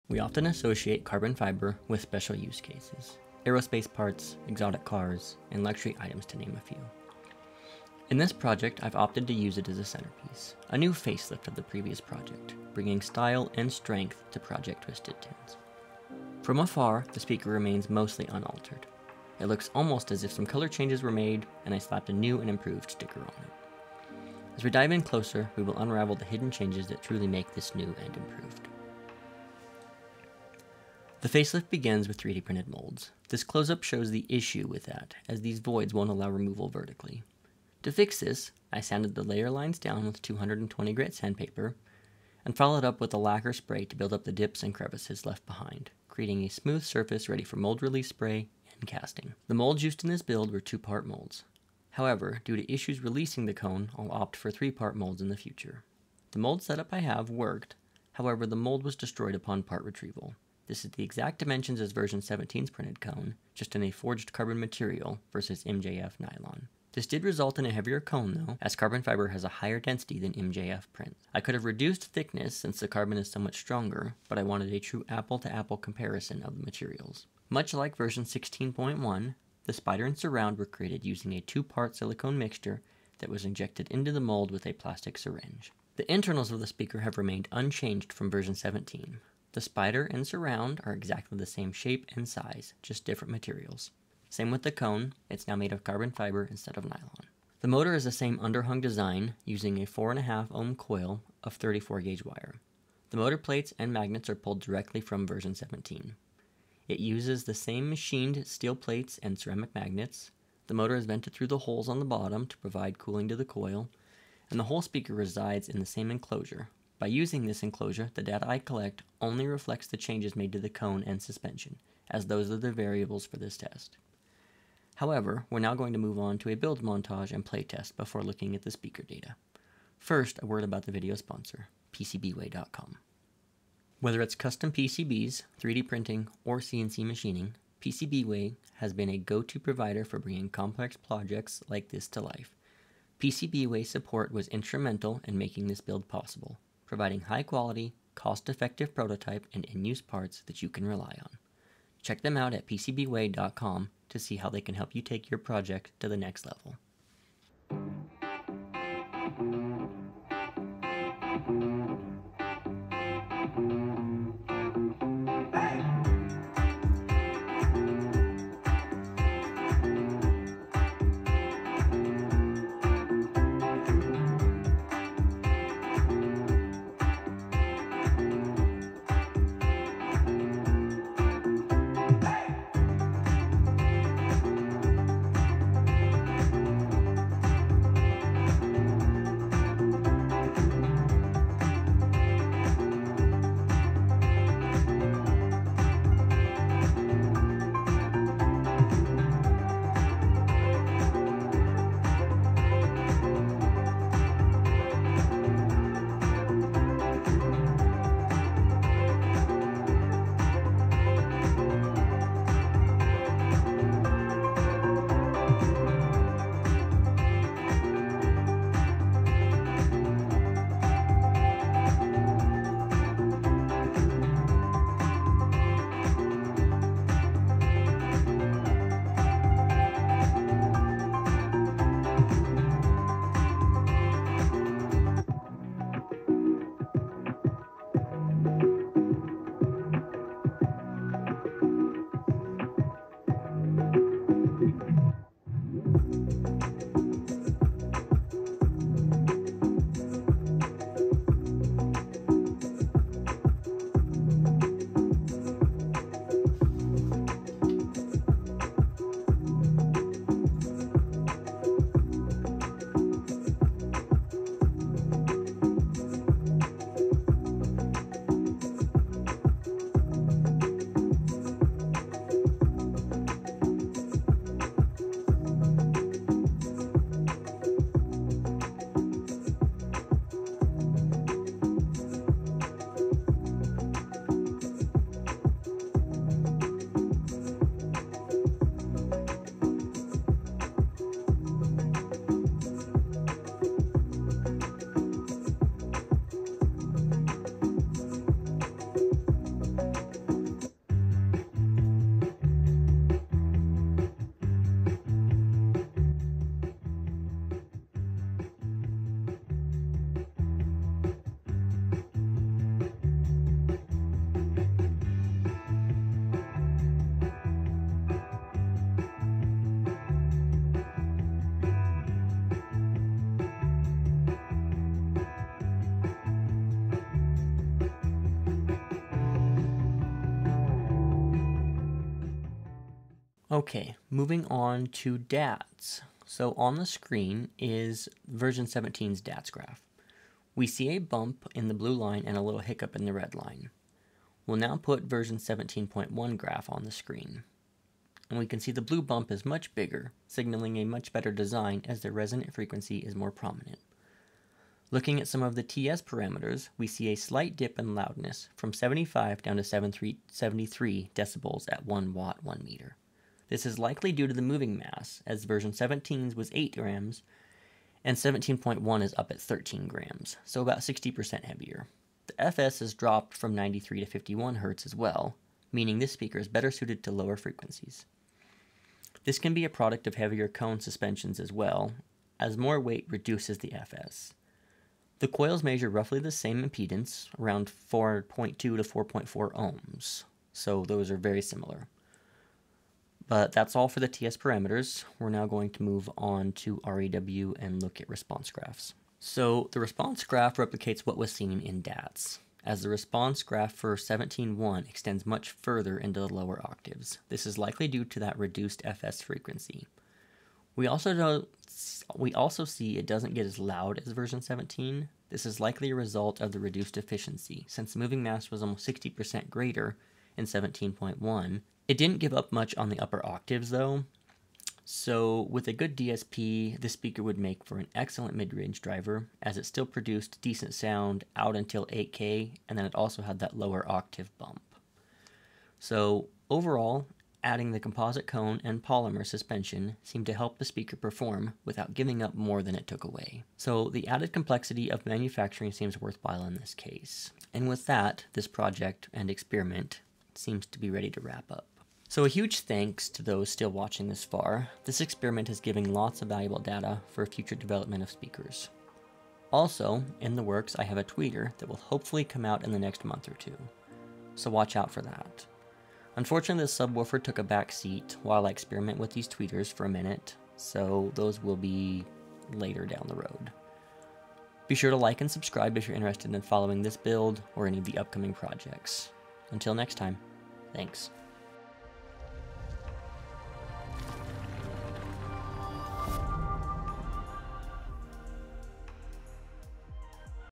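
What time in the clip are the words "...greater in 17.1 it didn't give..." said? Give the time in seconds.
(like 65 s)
419 s.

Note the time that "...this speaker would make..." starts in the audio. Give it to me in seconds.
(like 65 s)
426 s.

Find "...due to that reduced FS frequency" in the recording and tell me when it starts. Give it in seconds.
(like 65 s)
407 s.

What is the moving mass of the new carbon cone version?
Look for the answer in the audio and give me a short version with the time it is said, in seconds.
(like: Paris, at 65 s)
13 grams, at 369 s.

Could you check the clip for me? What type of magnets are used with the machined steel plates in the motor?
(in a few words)
Ceramic.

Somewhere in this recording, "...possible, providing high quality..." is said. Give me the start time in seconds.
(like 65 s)
146 s.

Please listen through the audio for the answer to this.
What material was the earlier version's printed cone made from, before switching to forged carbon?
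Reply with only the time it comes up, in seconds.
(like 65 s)
65 s.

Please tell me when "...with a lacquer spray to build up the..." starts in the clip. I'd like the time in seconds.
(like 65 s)
42 s.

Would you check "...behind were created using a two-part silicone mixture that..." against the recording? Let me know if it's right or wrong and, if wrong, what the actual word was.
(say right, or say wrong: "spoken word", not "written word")
wrong: "surround", not "behind".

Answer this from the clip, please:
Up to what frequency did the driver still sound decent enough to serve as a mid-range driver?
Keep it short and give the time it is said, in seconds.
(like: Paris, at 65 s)
8K, at 431 s.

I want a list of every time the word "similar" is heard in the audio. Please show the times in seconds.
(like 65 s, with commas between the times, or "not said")
391 s.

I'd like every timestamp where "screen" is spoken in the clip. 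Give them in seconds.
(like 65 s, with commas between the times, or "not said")
336 s, 346 s.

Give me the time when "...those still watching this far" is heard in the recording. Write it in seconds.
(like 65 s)
453 s.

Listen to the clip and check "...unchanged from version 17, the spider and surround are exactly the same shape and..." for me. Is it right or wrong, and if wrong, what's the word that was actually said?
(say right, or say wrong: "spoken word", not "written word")
right.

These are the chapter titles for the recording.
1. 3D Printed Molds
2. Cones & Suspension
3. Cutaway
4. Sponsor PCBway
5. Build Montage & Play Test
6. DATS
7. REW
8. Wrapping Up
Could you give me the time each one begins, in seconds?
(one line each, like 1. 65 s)
1. 31 s
2. 64 s
3. 85 s
4. 133 s
5. 158 s
6. 333 s
7. 396 s
8. 452 s.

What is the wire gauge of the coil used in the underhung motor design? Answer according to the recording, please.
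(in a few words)
34.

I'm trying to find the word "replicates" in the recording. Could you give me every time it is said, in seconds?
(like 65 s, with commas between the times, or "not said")
400 s.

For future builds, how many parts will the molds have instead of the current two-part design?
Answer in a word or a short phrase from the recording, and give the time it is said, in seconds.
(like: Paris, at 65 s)
3, at 54 s.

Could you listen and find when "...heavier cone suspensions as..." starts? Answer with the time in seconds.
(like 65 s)
380 s.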